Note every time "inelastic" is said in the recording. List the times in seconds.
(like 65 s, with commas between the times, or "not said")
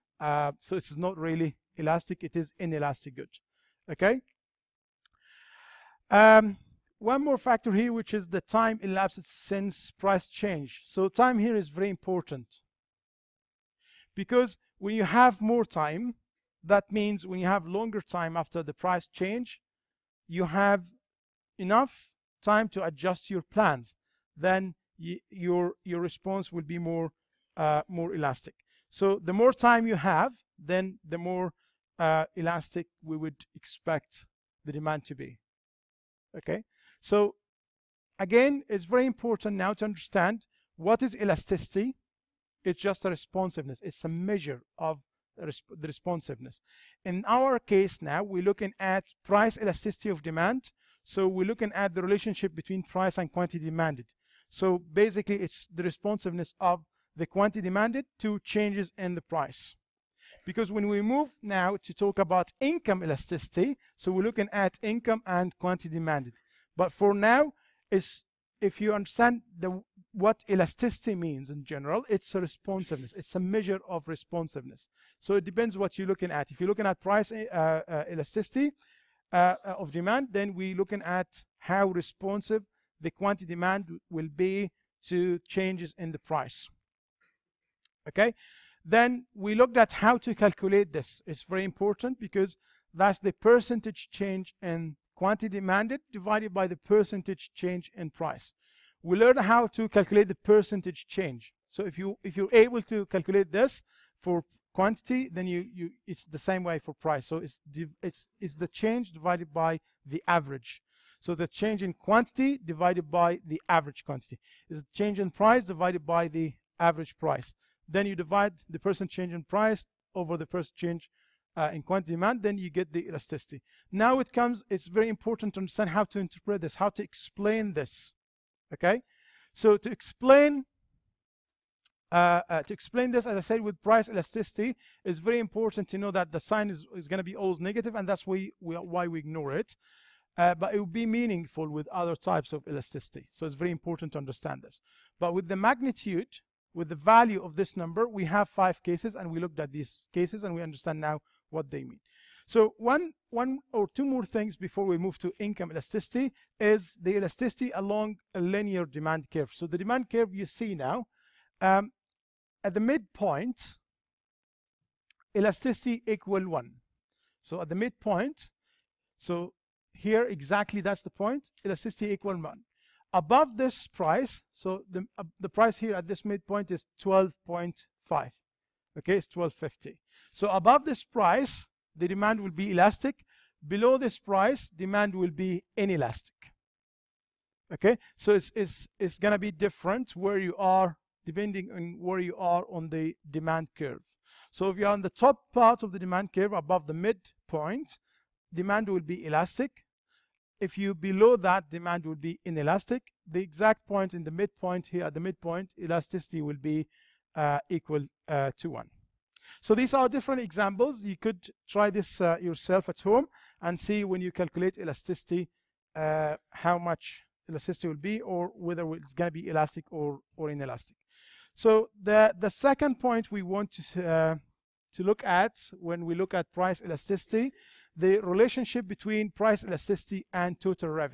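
2 s, 185 s, 202 s, 220 s.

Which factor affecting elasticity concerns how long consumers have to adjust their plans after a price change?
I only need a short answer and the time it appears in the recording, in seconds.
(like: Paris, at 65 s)
time elapsed since price change, at 8 s.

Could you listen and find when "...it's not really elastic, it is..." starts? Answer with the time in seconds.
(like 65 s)
0 s.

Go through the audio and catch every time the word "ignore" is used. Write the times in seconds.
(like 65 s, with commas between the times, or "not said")
139 s.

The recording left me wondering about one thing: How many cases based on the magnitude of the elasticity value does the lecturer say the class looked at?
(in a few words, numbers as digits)
5.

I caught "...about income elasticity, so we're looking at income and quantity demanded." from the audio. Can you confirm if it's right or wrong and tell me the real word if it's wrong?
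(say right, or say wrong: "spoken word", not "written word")
right.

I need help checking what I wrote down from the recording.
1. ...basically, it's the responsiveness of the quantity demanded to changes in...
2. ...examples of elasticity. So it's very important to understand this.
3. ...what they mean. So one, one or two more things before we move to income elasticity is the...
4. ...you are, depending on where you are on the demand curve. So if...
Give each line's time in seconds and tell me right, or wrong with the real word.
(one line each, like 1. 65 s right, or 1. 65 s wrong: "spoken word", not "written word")
1. 54 s right
2. 142 s wrong: "types", not "examples"
3. 151 s right
4. 190 s right.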